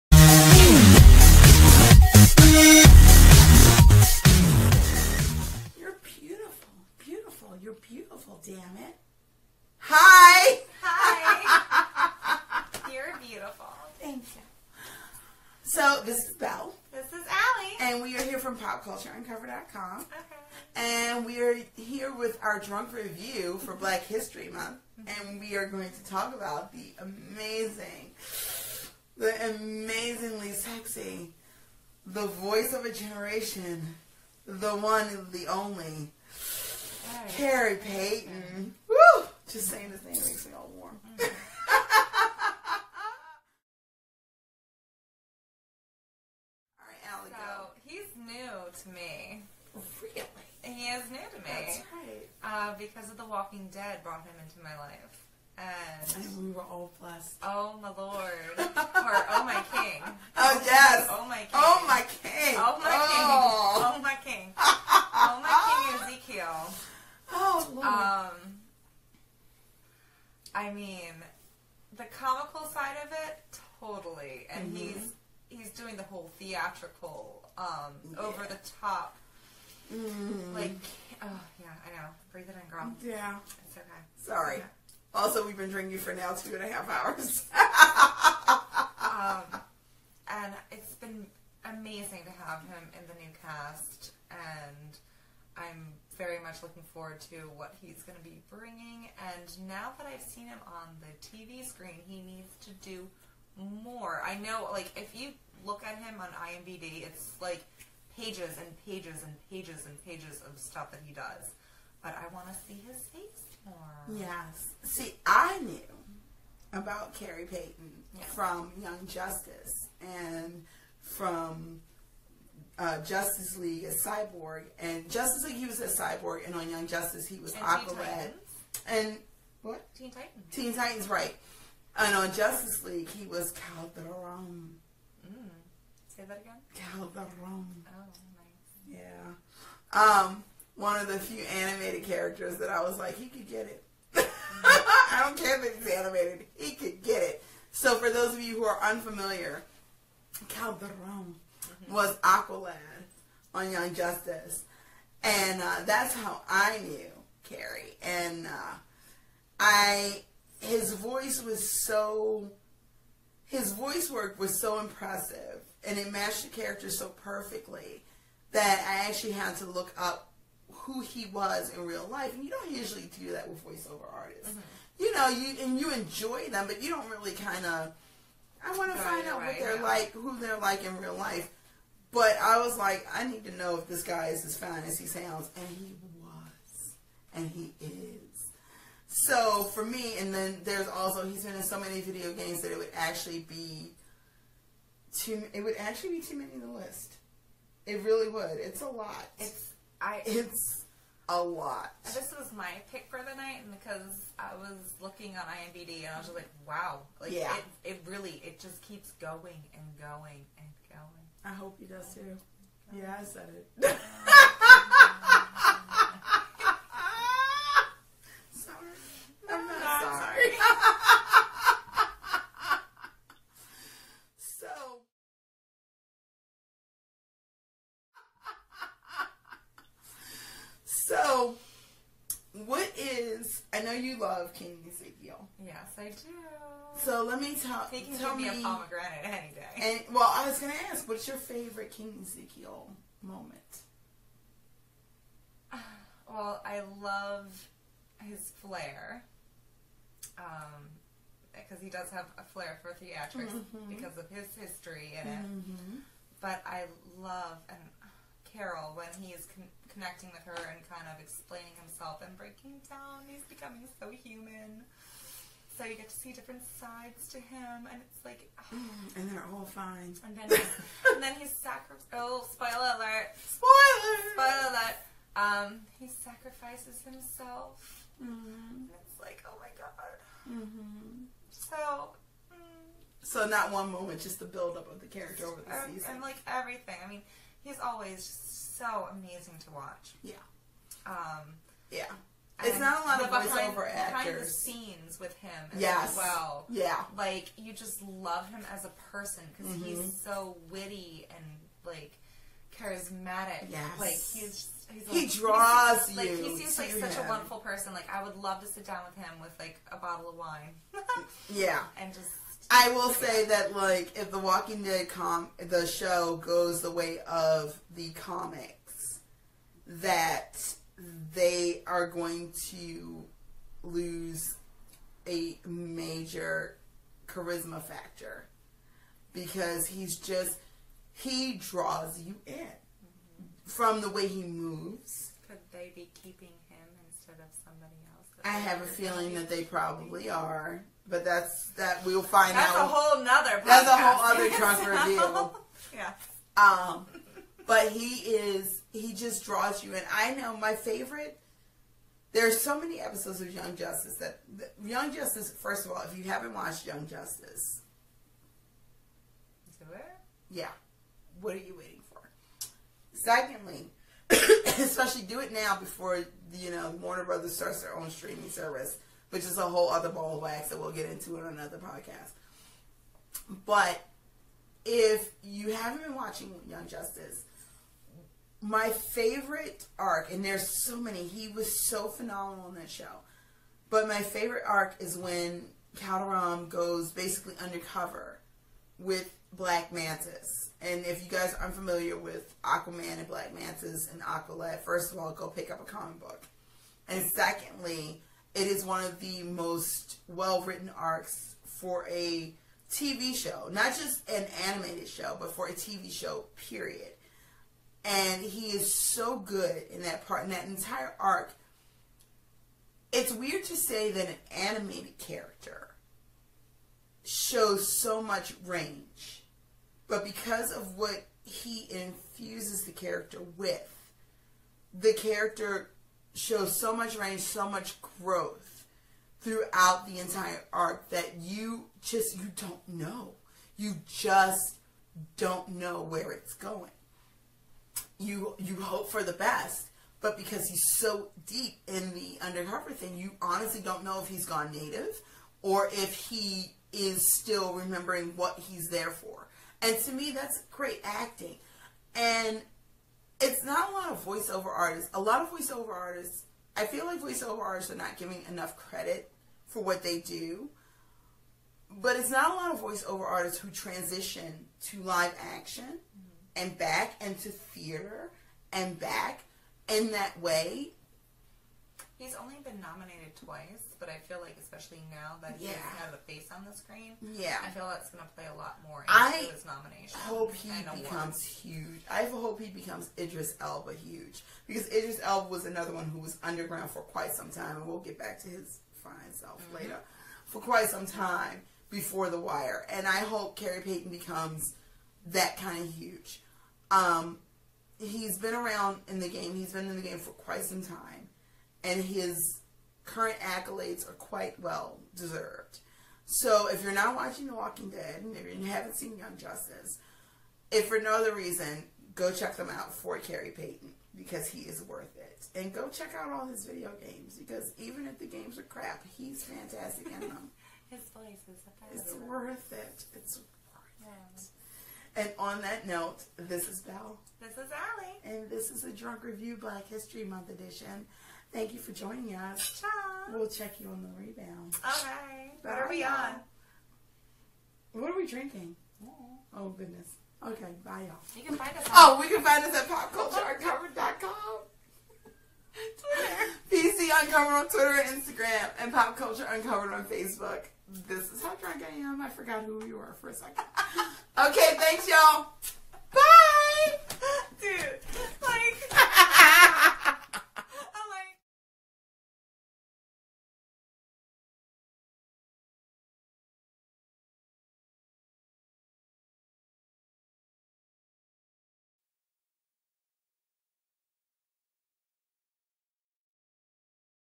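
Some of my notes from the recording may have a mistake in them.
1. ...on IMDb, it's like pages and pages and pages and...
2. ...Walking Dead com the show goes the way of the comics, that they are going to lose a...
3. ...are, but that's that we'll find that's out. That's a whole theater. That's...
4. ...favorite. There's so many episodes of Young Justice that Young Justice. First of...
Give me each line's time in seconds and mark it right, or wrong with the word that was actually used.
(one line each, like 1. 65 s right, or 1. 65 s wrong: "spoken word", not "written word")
1. 106 s right
2. 314 s right
3. 340 s wrong: "nother", not "theater"
4. 350 s right.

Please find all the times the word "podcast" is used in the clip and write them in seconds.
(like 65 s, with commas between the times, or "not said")
371 s.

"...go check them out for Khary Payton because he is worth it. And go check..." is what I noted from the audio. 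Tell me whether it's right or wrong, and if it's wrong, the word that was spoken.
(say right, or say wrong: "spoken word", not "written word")
right.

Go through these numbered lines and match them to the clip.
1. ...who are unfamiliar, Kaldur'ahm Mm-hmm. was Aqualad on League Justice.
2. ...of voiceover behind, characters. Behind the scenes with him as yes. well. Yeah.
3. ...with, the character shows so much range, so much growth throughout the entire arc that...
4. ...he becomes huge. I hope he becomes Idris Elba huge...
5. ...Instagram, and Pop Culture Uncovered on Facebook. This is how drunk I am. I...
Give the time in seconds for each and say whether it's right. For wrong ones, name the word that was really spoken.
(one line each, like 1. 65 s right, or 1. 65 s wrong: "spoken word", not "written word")
1. 148 s wrong: "Young", not "League"
2. 293 s wrong: "actors", not "characters"
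3. 423 s right
4. 480 s right
5. 548 s right.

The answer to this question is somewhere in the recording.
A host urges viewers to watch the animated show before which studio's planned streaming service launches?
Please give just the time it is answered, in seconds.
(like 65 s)
367 s.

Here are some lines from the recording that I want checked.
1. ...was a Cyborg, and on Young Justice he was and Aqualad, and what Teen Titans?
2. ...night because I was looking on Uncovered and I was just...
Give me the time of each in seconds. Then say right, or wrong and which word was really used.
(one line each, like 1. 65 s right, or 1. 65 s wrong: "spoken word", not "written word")
1. 125 s right
2. 203 s wrong: "IMDb", not "Uncovered".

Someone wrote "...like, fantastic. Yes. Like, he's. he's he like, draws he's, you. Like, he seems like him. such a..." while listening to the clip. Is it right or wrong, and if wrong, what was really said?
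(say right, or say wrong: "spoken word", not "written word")
wrong: "charismatic", not "fantastic".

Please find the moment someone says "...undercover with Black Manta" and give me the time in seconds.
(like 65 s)
387 s.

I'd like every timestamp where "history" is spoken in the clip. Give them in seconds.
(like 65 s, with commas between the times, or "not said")
24 s, 254 s, 529 s.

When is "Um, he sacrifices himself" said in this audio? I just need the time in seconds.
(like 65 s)
275 s.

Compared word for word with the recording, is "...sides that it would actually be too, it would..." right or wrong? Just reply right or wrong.
wrong.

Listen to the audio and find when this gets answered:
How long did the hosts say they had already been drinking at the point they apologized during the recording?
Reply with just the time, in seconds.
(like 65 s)
86 s.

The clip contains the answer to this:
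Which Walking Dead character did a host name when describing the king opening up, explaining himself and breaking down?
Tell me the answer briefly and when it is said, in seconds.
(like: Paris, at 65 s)
Carol, at 258 s.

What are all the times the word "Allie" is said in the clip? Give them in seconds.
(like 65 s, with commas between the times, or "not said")
17 s, 527 s.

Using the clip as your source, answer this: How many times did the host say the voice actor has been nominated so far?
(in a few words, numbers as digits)
2.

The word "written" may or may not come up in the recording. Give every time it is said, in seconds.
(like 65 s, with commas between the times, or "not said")
400 s.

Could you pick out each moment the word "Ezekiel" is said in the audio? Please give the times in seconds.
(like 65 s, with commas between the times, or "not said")
66 s, 234 s, 242 s.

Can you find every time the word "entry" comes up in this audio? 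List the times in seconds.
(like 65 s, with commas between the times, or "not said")
not said.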